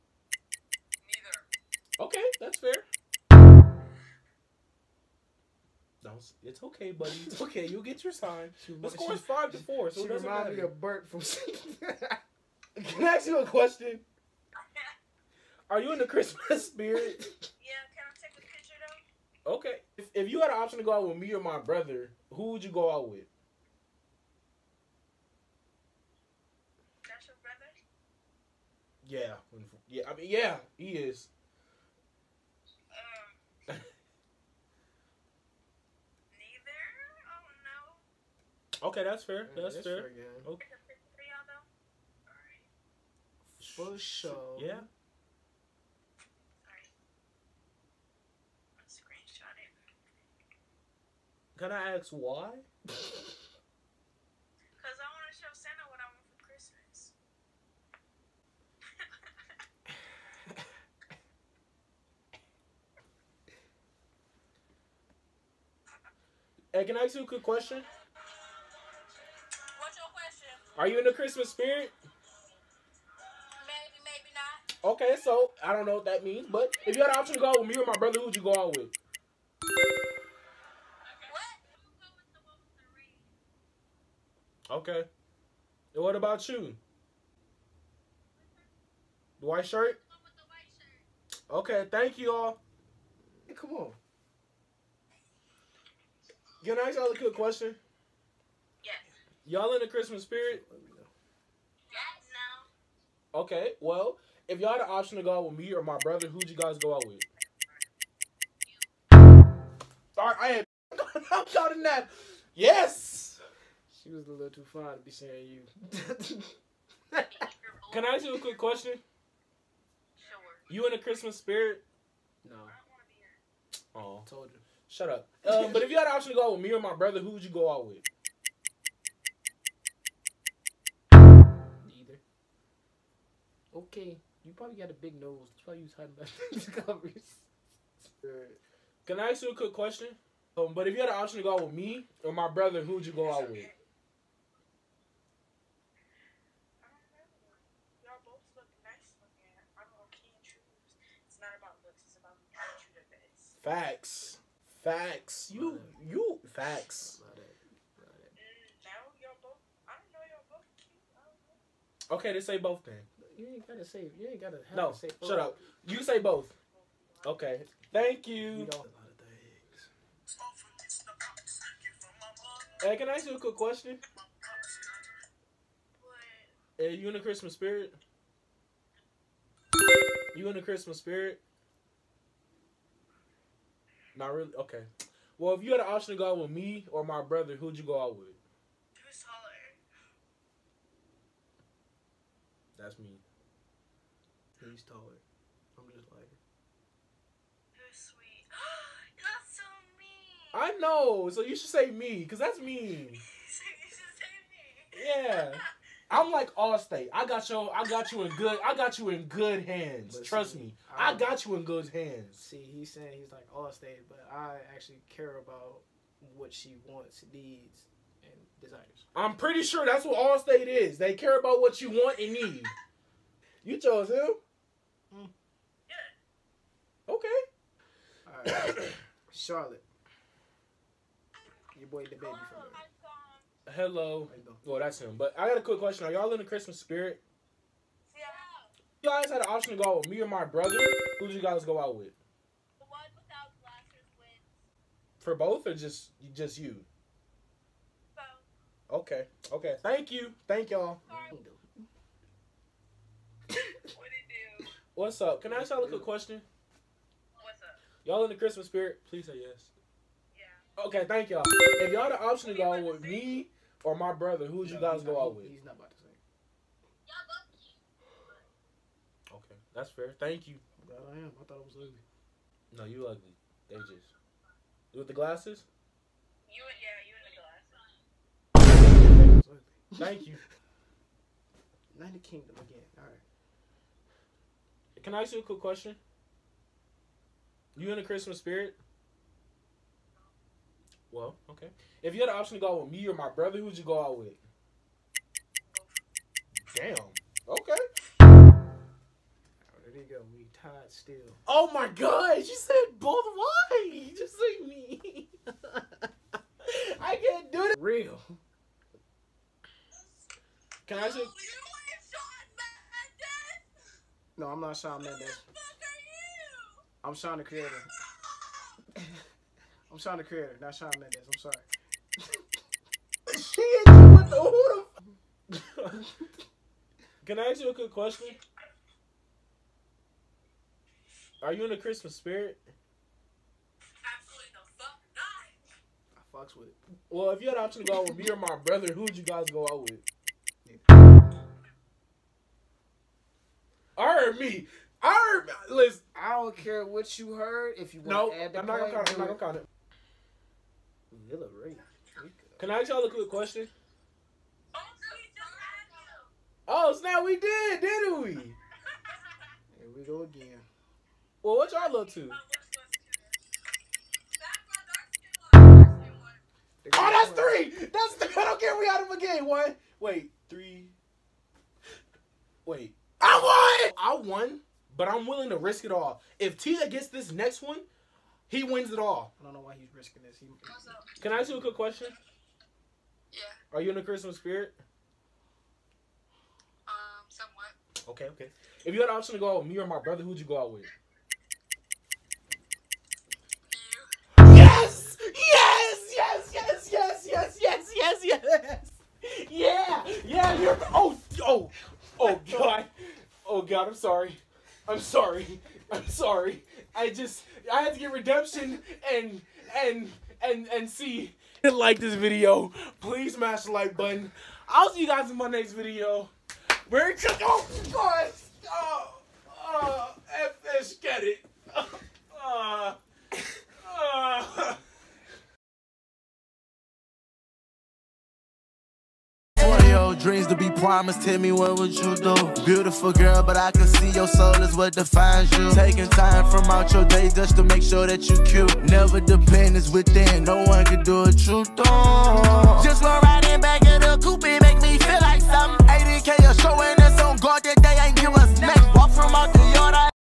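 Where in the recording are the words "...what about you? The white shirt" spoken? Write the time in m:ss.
1:26.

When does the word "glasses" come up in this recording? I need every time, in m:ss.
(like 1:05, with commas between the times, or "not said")
4:03, 4:35, 4:39.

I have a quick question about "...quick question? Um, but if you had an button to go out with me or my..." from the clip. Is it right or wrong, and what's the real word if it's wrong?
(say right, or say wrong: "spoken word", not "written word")
wrong: "option", not "button".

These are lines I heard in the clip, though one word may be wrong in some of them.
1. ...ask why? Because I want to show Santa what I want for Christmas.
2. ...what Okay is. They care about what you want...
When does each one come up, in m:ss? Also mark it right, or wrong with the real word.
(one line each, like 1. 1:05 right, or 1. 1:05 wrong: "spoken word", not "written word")
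1. 0:51 right
2. 3:40 wrong: "Allstate", not "Okay".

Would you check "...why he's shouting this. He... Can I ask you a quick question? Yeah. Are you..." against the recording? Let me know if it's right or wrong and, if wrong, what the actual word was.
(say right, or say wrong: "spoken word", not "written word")
wrong: "risking", not "shouting".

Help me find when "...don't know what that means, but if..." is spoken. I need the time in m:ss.
1:15.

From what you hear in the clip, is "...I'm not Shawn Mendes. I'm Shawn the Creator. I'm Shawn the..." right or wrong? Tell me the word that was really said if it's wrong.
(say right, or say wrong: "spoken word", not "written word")
right.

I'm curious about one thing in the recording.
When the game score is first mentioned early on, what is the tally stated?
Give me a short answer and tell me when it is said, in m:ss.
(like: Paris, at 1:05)
5 to 4, at 0:09.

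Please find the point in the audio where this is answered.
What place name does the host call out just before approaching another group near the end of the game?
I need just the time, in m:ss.
5:51.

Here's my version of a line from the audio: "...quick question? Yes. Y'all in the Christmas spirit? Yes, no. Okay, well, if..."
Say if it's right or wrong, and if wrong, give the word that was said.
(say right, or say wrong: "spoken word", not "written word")
right.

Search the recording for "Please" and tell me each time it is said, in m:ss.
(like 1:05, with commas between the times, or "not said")
4:19, 6:52.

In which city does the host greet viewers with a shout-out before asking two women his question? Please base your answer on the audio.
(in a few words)
Charlotte.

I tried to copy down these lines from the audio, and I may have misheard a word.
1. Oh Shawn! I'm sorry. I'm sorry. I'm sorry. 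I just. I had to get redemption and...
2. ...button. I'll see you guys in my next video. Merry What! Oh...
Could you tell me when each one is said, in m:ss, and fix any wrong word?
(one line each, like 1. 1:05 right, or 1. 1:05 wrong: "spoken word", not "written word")
1. 6:43 wrong: "God", not "Shawn"
2. 6:53 wrong: "Christmas", not "What".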